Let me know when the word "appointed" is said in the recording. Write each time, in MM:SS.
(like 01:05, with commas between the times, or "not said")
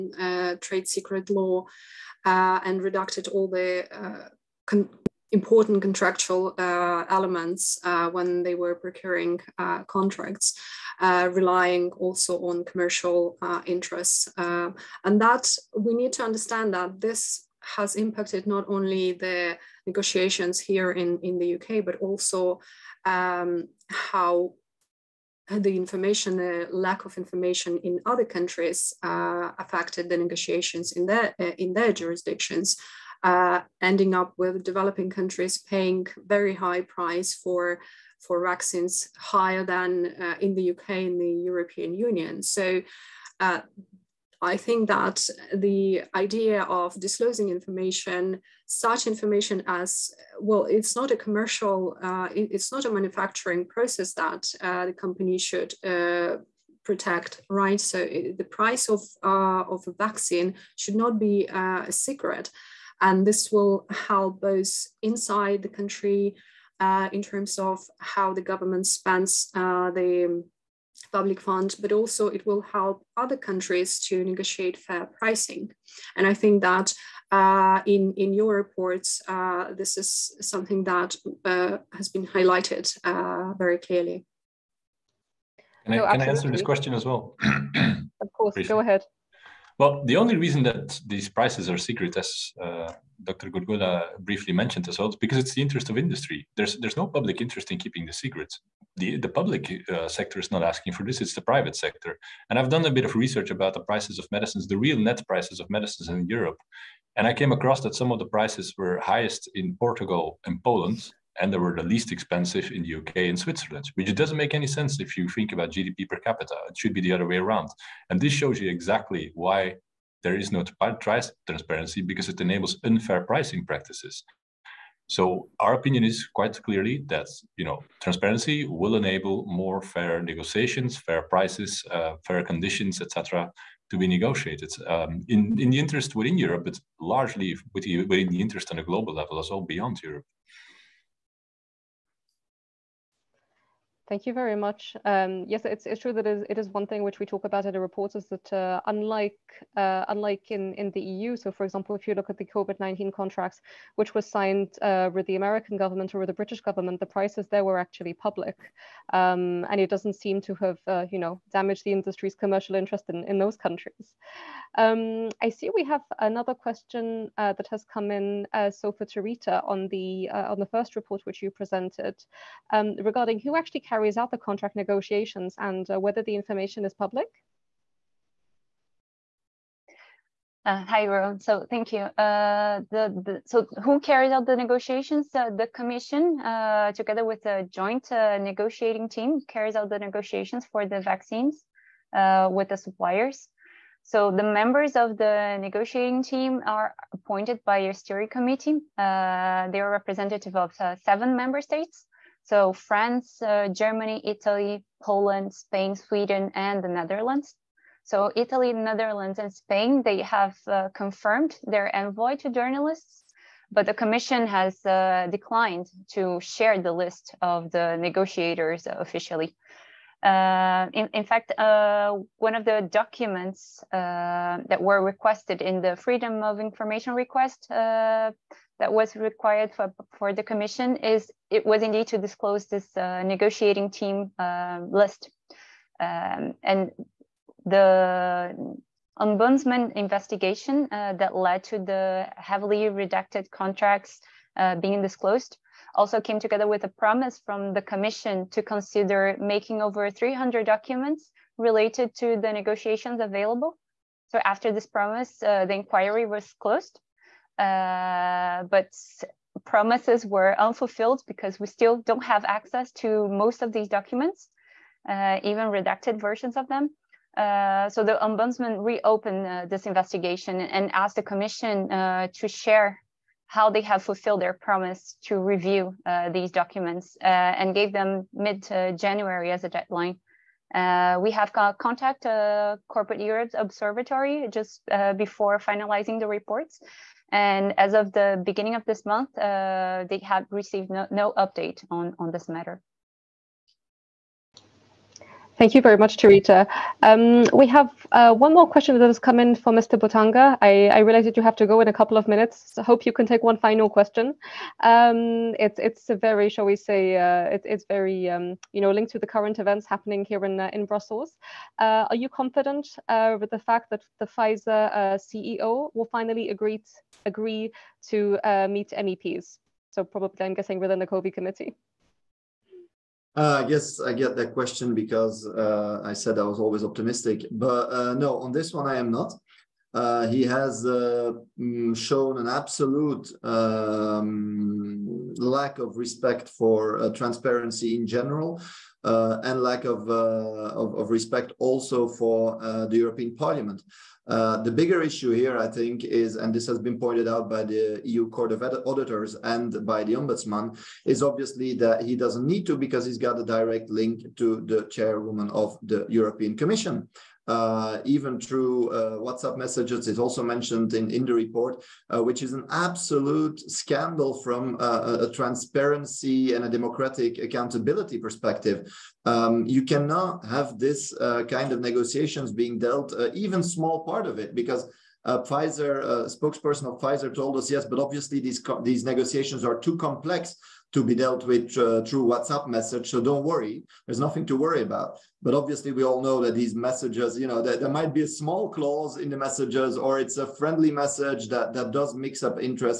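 03:17.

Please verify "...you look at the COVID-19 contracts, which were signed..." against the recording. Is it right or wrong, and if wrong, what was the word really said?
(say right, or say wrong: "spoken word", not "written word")
right.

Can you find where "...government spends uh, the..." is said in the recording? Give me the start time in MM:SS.
01:08.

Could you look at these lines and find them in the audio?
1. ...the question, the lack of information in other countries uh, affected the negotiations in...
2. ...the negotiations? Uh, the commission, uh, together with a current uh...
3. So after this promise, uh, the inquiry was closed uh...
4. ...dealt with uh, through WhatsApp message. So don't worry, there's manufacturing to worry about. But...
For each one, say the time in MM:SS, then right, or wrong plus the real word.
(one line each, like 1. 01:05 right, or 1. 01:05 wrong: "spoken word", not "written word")
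1. 00:25 wrong: "information", not "question"
2. 03:04 wrong: "joint", not "current"
3. 04:14 right
4. 06:21 wrong: "nothing", not "manufacturing".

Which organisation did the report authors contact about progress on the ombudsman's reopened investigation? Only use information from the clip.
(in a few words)
Corporate Europe Observatory.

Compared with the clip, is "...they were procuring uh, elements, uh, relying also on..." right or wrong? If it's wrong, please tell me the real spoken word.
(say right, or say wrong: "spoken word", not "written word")
wrong: "contracts", not "elements".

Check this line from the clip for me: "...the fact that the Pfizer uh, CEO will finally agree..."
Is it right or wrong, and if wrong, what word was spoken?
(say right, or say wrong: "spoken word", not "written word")
right.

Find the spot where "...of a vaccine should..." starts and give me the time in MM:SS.
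00:59.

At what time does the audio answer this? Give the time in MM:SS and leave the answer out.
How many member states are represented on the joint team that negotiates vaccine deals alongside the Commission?
03:21.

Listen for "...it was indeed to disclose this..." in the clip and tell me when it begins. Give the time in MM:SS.
03:51.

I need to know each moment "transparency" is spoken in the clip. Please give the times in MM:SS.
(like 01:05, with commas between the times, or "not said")
02:00, 02:08, 05:37, 06:05.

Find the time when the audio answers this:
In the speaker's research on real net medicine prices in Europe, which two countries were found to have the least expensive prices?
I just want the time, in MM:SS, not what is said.
01:52.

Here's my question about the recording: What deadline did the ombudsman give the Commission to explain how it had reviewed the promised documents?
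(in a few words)
mid-January.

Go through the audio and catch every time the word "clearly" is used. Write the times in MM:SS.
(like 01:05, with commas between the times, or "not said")
01:23, 02:06.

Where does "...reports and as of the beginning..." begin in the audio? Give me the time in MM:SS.
04:46.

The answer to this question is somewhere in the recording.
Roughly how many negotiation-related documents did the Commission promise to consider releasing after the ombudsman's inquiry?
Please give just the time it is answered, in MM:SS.
04:09.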